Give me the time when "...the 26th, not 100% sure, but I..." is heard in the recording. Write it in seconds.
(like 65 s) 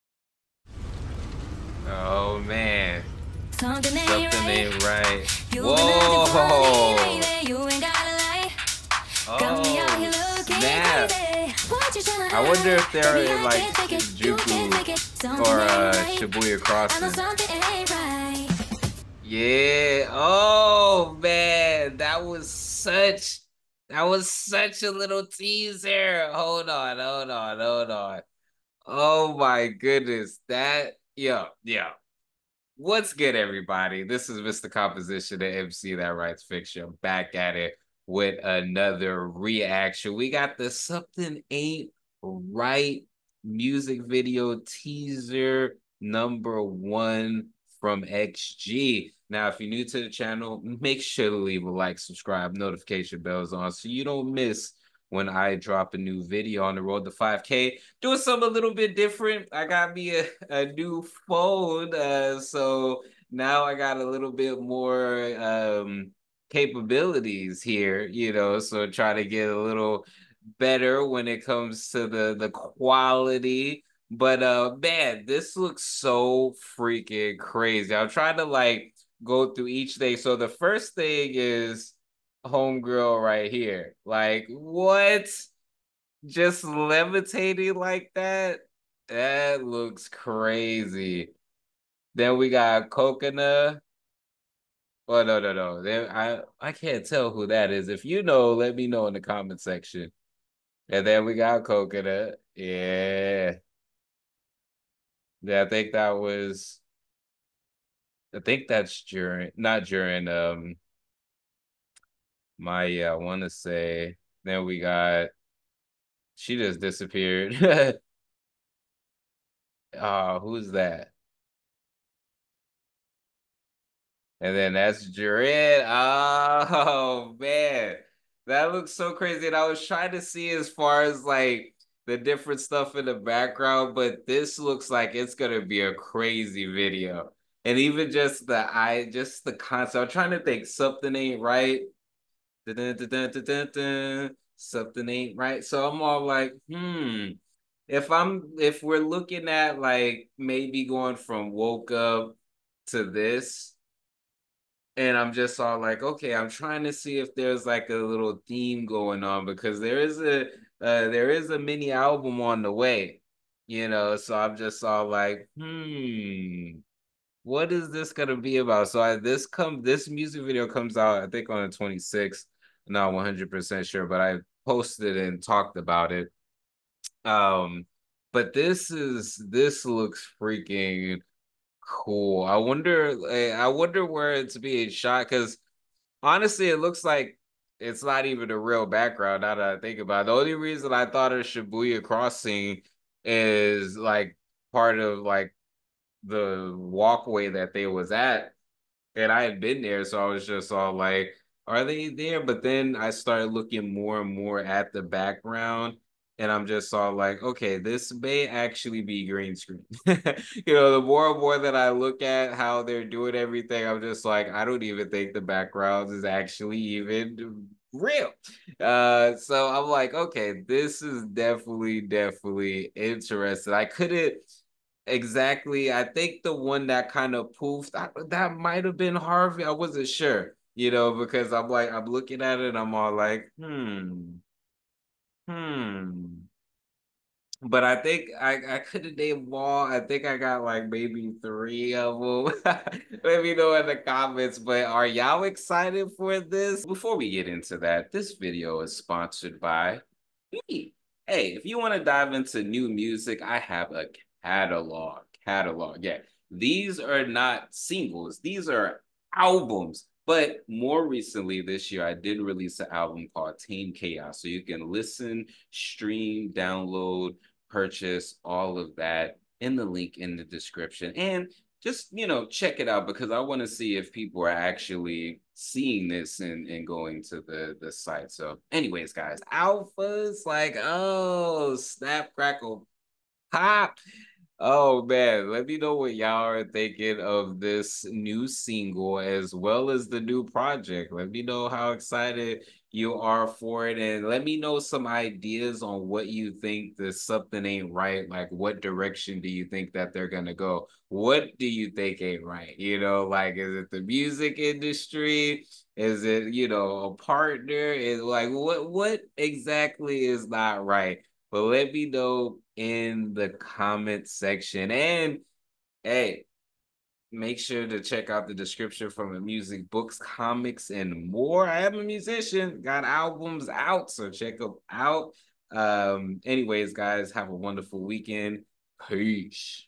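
171 s.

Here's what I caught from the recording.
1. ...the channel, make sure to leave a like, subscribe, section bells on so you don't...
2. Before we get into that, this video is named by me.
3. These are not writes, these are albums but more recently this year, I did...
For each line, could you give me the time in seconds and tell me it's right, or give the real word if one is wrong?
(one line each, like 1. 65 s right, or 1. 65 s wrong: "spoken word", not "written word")
1. 49 s wrong: "notification", not "section"
2. 246 s wrong: "sponsored", not "named"
3. 256 s wrong: "singles", not "writes".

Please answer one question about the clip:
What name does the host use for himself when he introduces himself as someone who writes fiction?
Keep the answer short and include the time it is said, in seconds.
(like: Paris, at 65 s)
Mr. Composition, at 34 s.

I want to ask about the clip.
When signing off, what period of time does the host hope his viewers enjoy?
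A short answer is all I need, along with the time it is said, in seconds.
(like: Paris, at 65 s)
Weekend, at 328 s.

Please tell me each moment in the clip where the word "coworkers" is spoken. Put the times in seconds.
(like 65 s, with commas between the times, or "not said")
not said.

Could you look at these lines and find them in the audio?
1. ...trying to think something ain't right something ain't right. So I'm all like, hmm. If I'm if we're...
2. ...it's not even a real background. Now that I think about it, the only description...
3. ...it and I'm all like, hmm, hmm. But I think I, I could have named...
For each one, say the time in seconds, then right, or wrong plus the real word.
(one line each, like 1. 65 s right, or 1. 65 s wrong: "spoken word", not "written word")
1. 140 s right
2. 187 s wrong: "reason", not "description"
3. 232 s right.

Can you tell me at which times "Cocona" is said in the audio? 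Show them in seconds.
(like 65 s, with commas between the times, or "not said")
92 s, 101 s.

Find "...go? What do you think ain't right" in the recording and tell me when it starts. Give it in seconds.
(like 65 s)
300 s.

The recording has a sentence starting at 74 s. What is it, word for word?
But uh man, this looks so freaking crazy.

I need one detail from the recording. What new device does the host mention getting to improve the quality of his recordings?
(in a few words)
A new phone.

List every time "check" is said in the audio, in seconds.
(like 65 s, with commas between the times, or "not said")
272 s, 317 s, 324 s.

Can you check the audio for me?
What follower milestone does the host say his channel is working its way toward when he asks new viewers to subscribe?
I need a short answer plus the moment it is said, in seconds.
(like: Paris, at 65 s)
5K, at 57 s.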